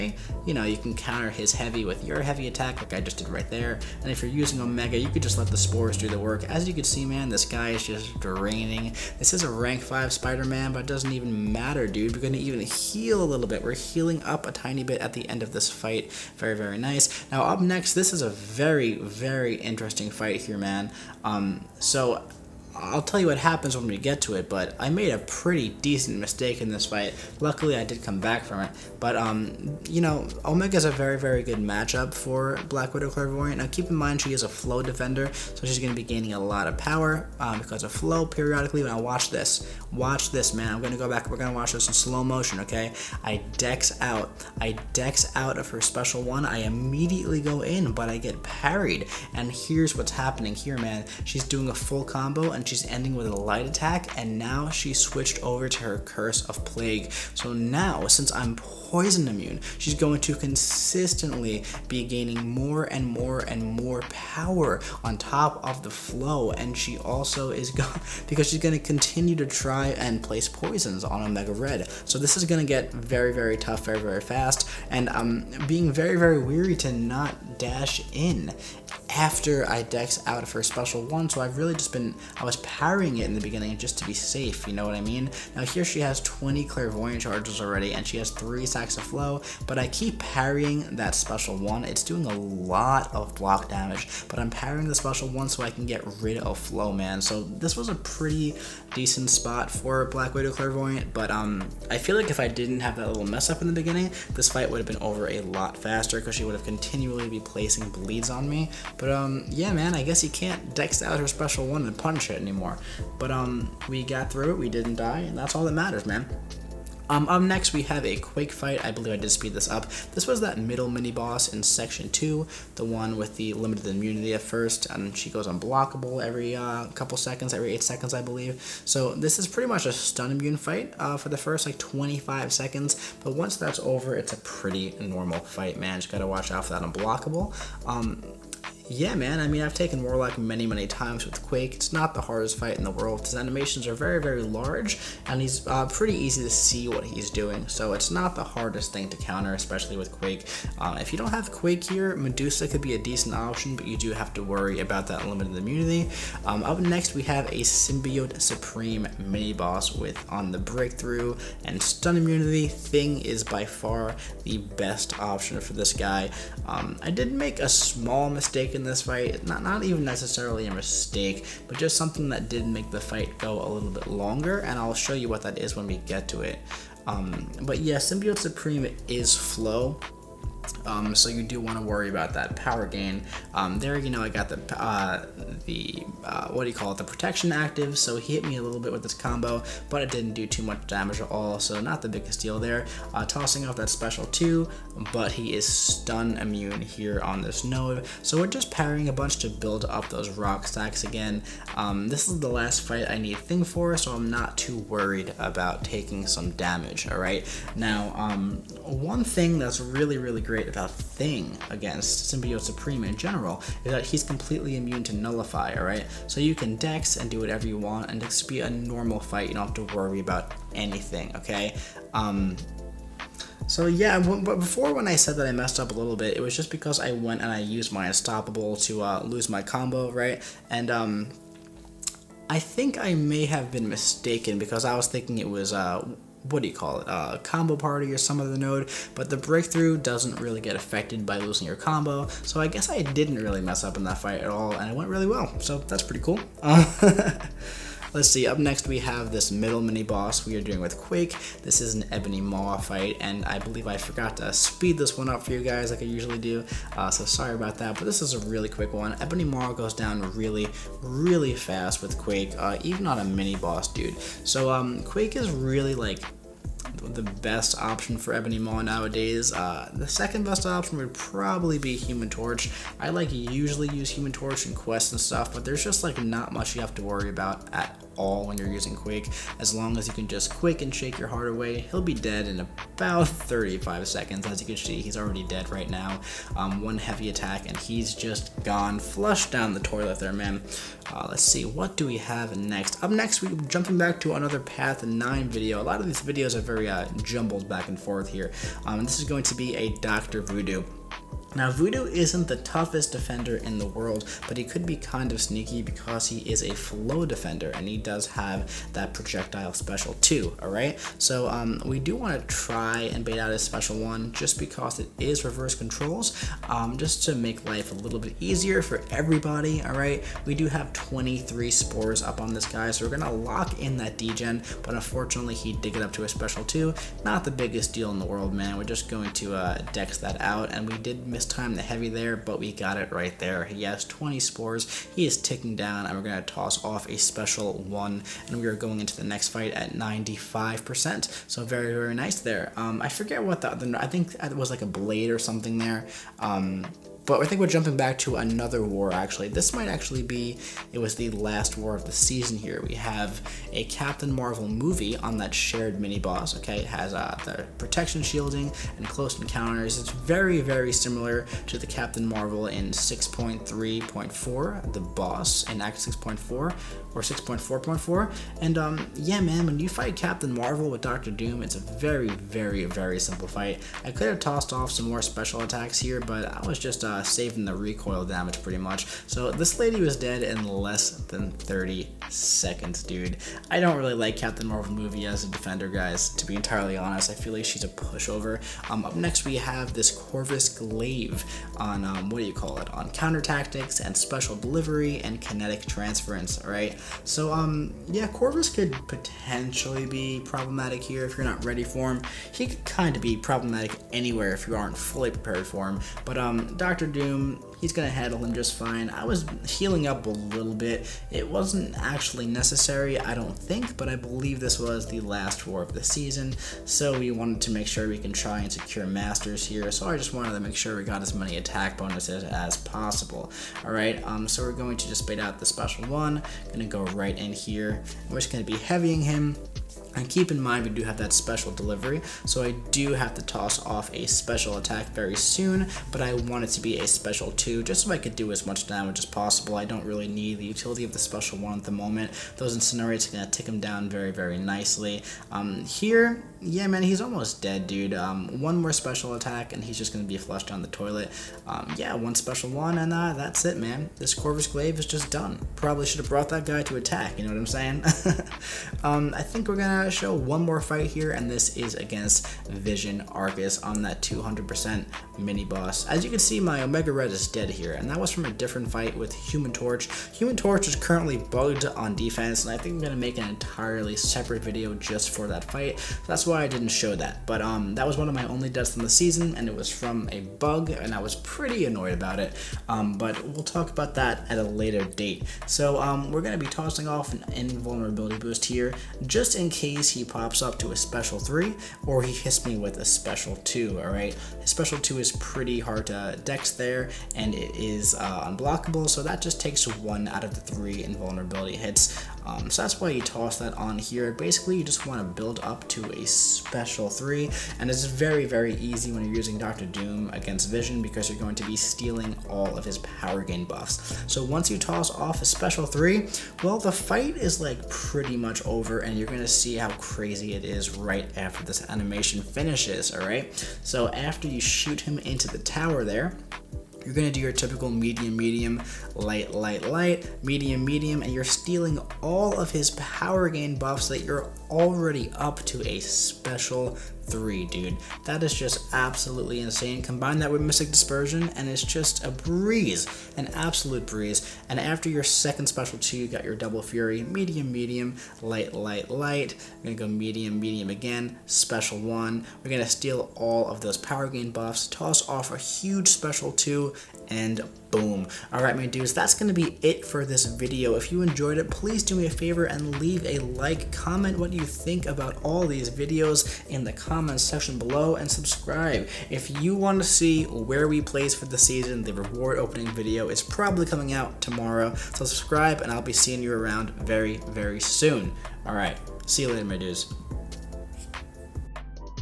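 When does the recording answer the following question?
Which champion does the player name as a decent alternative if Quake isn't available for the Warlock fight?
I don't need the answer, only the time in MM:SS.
02:32.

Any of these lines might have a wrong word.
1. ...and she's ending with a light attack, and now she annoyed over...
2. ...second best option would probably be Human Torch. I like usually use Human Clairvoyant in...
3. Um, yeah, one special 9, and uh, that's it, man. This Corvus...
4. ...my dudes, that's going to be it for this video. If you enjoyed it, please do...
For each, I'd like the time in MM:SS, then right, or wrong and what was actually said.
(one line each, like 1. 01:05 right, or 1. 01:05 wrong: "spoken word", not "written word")
1. 00:52 wrong: "switched", not "annoyed"
2. 04:30 wrong: "Torch", not "Clairvoyant"
3. 07:31 wrong: "1", not "9"
4. 09:18 right.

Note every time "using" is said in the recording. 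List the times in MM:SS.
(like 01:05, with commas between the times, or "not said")
00:04, 04:38, 08:29.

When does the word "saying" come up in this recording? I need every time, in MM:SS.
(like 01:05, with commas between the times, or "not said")
07:37.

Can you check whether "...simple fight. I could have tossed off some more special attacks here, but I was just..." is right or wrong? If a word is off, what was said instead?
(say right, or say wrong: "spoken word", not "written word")
right.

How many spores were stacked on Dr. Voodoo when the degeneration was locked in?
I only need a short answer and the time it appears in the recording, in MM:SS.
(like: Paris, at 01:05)
23, at 05:20.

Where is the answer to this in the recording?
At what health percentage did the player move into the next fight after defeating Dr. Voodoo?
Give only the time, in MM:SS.
05:39.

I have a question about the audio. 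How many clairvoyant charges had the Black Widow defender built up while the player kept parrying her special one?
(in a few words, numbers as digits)
20.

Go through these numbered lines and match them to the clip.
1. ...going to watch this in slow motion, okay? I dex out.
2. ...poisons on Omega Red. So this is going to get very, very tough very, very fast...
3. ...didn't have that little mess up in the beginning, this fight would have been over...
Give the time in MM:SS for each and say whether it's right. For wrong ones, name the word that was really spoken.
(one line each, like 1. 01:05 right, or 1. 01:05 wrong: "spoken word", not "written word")
1. 00:41 right
2. 01:10 right
3. 01:42 right.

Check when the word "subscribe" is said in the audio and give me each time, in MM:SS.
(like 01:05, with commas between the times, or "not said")
09:28, 09:35.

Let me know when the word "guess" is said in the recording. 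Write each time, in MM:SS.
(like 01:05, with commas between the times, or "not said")
01:50, 04:02.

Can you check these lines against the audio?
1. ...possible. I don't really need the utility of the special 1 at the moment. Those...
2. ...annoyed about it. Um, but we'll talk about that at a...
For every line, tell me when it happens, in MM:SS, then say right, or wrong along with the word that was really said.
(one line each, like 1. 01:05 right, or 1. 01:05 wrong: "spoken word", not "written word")
1. 07:19 right
2. 08:01 right.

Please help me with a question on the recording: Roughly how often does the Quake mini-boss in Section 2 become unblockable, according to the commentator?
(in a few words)
every 8 seconds.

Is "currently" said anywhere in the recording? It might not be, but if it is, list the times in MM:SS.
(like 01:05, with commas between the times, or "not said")
07:50.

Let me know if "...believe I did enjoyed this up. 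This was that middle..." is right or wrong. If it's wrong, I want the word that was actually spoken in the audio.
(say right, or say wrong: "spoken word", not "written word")
wrong: "speed", not "enjoyed".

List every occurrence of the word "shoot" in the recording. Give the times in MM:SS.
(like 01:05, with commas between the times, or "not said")
08:44.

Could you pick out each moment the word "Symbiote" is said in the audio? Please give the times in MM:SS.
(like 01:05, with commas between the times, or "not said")
02:37, 02:57, 03:32.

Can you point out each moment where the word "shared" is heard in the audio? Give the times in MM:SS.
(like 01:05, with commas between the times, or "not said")
05:55.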